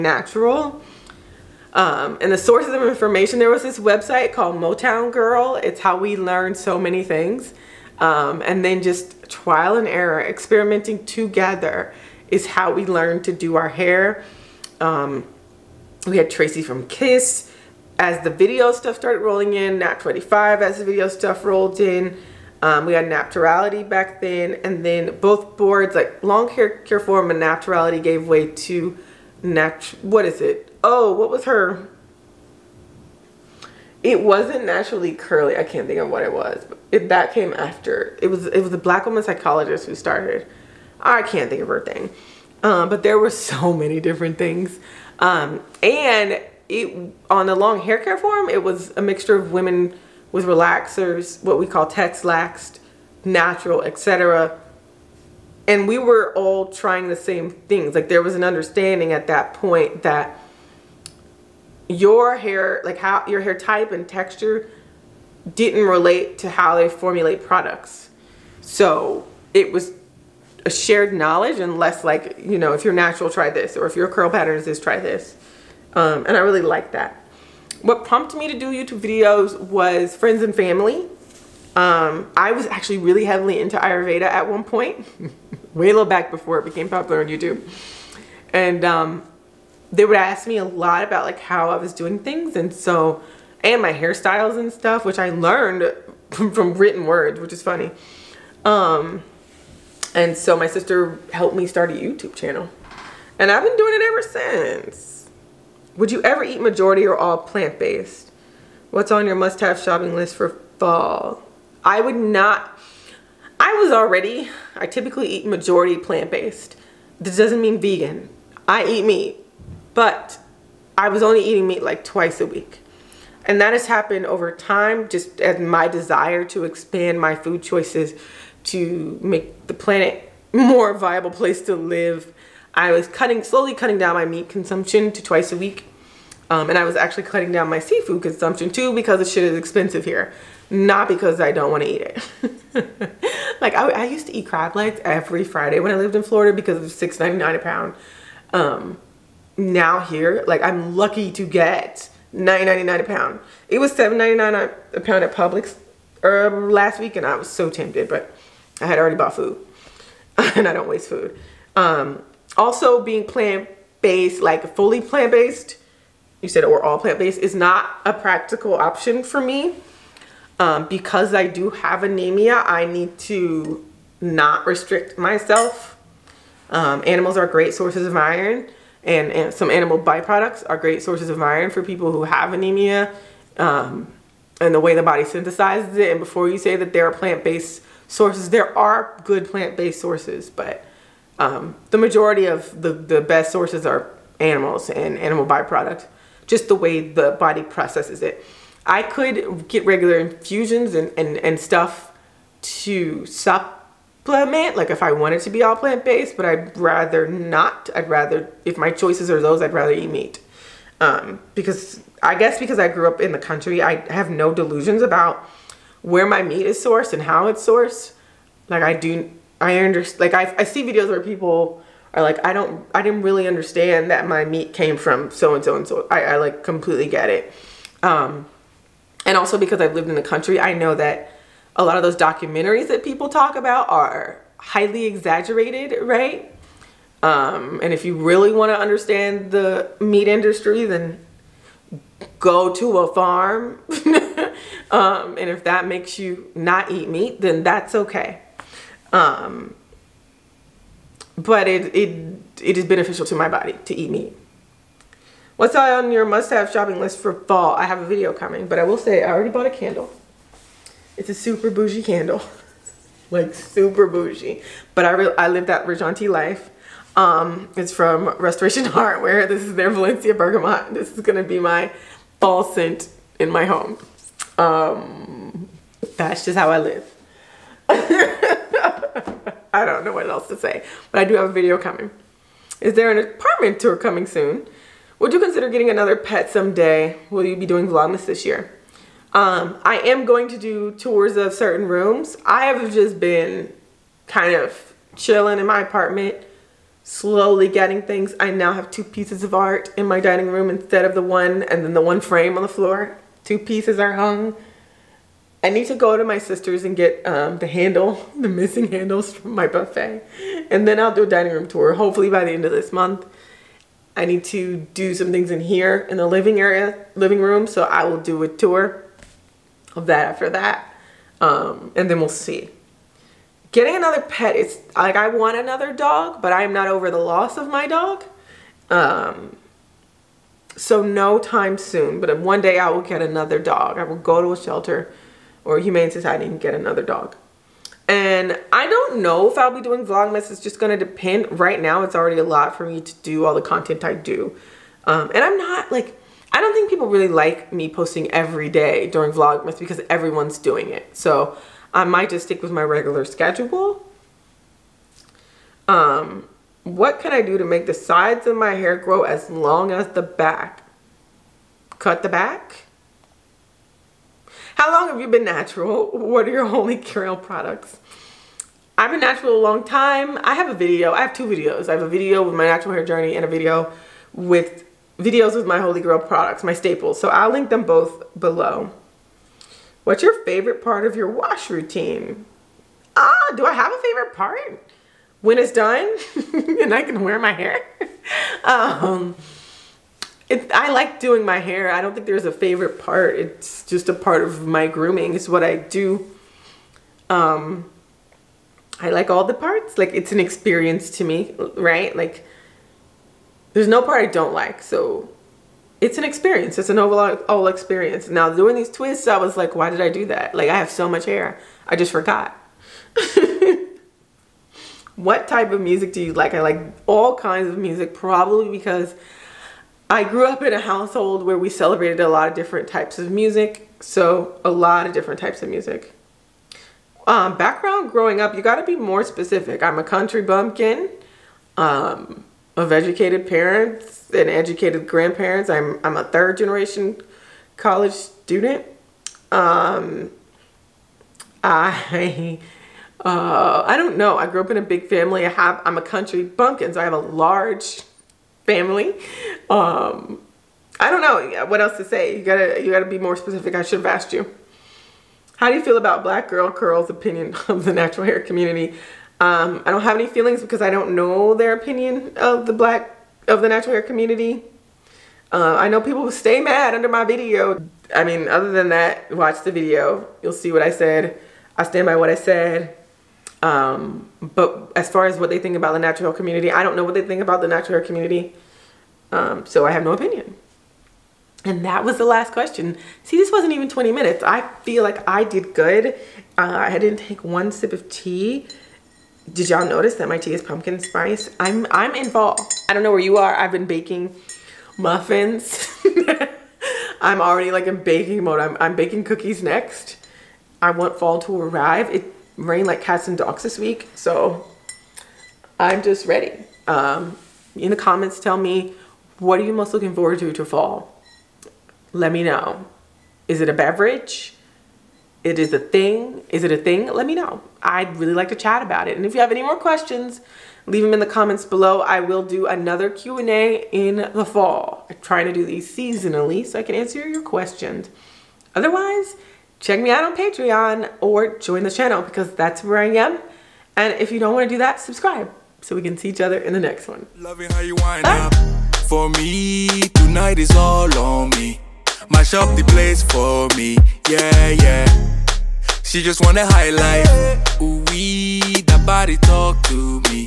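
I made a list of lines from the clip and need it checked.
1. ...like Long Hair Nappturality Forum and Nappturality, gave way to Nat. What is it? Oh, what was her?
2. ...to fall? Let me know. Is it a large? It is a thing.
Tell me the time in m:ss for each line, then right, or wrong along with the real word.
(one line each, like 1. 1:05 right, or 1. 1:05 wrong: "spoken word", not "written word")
1. 0:25 wrong: "Care", not "Nappturality"
2. 8:30 wrong: "beverage", not "large".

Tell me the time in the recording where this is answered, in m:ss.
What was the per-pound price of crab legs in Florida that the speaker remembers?
2:26.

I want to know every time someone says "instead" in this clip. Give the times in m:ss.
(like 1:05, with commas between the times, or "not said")
5:00.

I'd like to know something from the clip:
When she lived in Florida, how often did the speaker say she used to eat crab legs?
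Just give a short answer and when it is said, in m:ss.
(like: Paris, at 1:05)
Every Friday, at 2:25.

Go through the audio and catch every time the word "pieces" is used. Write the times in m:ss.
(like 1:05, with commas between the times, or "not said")
4:59, 5:03.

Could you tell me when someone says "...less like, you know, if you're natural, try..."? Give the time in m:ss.
1:11.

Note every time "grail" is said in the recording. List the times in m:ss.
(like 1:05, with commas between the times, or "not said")
6:06, 6:15.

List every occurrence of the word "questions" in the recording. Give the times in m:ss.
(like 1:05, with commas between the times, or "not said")
8:02, 8:39, 8:47.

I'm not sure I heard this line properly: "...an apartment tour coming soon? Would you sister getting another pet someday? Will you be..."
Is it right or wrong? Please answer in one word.
wrong.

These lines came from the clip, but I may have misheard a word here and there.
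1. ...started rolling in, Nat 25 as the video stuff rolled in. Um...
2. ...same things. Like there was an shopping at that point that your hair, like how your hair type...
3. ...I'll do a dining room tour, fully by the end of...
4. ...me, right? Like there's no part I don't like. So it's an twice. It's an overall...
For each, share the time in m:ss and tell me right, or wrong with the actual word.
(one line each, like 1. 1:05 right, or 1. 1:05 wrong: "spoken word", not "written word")
1. 0:18 right
2. 0:57 wrong: "understanding", not "shopping"
3. 5:10 wrong: "hopefully", not "fully"
4. 6:41 wrong: "experience", not "twice".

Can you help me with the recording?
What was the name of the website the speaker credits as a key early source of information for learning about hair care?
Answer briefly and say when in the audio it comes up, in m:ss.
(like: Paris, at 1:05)
Motown Girl, at 0:04.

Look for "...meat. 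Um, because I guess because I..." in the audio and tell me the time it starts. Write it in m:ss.
3:30.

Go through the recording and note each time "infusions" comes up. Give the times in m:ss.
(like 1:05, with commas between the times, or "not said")
3:20.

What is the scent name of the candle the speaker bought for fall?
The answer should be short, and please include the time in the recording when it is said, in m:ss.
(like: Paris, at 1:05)
Valencia Bergamot, at 4:29.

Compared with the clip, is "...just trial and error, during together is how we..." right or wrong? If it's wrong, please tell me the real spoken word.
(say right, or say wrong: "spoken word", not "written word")
wrong: "experimenting", not "during".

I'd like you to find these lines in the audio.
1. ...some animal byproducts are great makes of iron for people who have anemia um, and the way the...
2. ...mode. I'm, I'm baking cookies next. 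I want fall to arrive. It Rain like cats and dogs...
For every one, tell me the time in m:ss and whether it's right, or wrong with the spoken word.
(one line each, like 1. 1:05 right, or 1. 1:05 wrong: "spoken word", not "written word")
1. 2:59 wrong: "sources", not "makes"
2. 8:18 right.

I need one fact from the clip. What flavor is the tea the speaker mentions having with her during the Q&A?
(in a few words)
Pumpkin spice.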